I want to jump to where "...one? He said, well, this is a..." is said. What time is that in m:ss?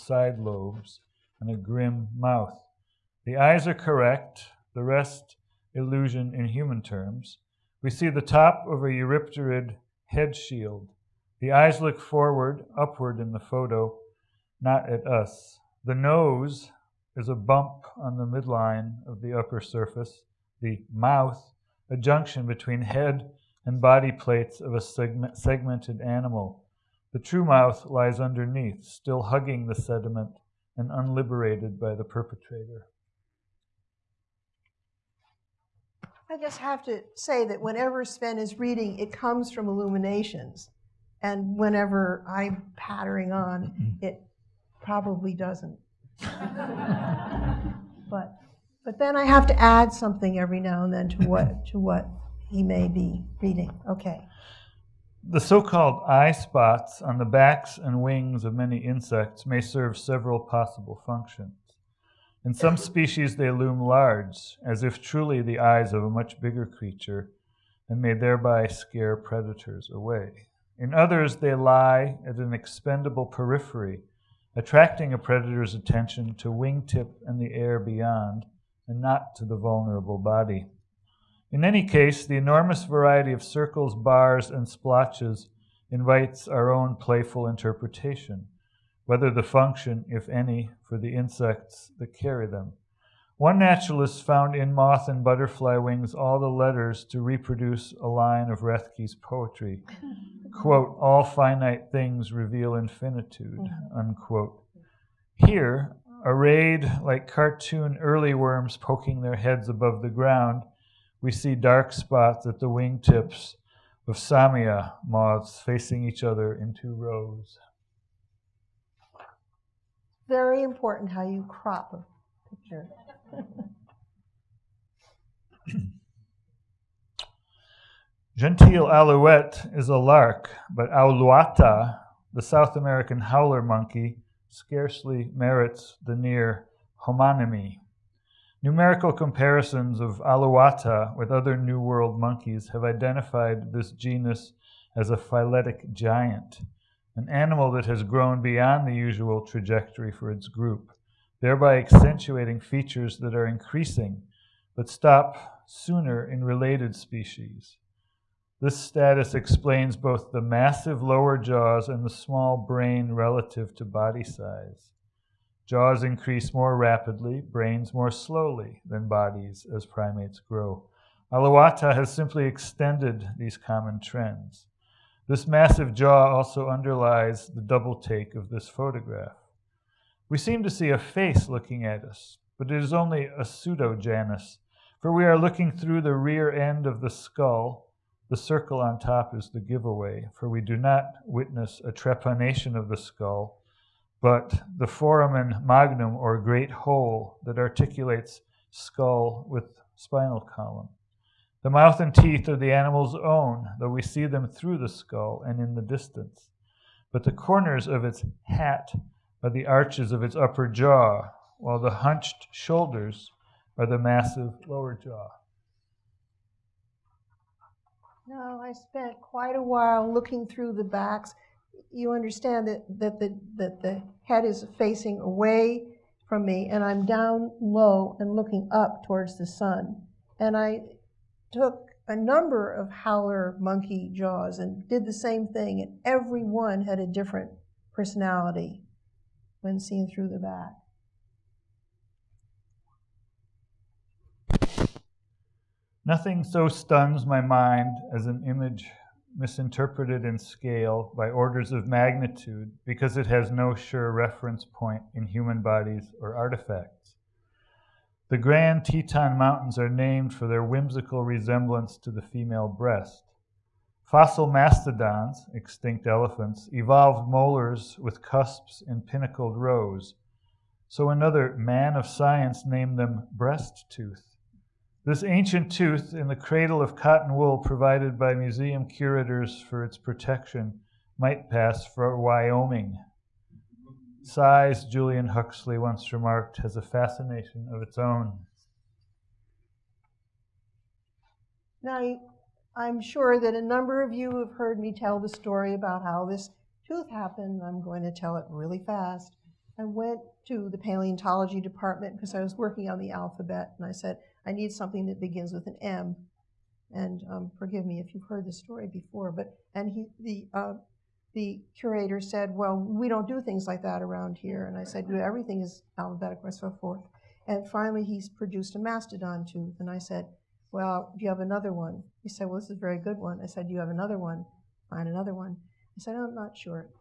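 5:21.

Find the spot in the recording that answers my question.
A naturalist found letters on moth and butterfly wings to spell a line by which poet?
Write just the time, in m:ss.
1:38.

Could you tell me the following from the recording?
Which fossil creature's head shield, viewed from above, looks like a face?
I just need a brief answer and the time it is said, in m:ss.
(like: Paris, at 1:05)
Eurypterid, at 0:08.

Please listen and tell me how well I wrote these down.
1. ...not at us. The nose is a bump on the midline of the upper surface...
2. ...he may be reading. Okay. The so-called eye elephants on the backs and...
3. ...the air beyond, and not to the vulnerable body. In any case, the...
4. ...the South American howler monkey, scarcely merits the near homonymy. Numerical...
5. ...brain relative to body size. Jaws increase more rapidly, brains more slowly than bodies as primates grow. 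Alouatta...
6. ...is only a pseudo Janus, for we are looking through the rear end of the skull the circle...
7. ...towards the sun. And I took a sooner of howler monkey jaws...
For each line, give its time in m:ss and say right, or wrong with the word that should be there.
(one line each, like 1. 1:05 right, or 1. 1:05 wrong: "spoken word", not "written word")
1. 0:14 right
2. 0:52 wrong: "spots", not "elephants"
3. 1:17 right
4. 2:12 right
5. 2:42 right
6. 3:02 right
7. 3:49 wrong: "number", not "sooner".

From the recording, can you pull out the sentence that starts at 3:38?
No, I spent quite a while looking through the backs.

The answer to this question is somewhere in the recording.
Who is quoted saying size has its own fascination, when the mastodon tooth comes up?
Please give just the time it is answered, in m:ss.
4:44.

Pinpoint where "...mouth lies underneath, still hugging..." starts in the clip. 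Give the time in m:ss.
0:27.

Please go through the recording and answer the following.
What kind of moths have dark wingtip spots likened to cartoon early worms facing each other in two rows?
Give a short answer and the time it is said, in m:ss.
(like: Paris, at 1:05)
Samia moths, at 1:54.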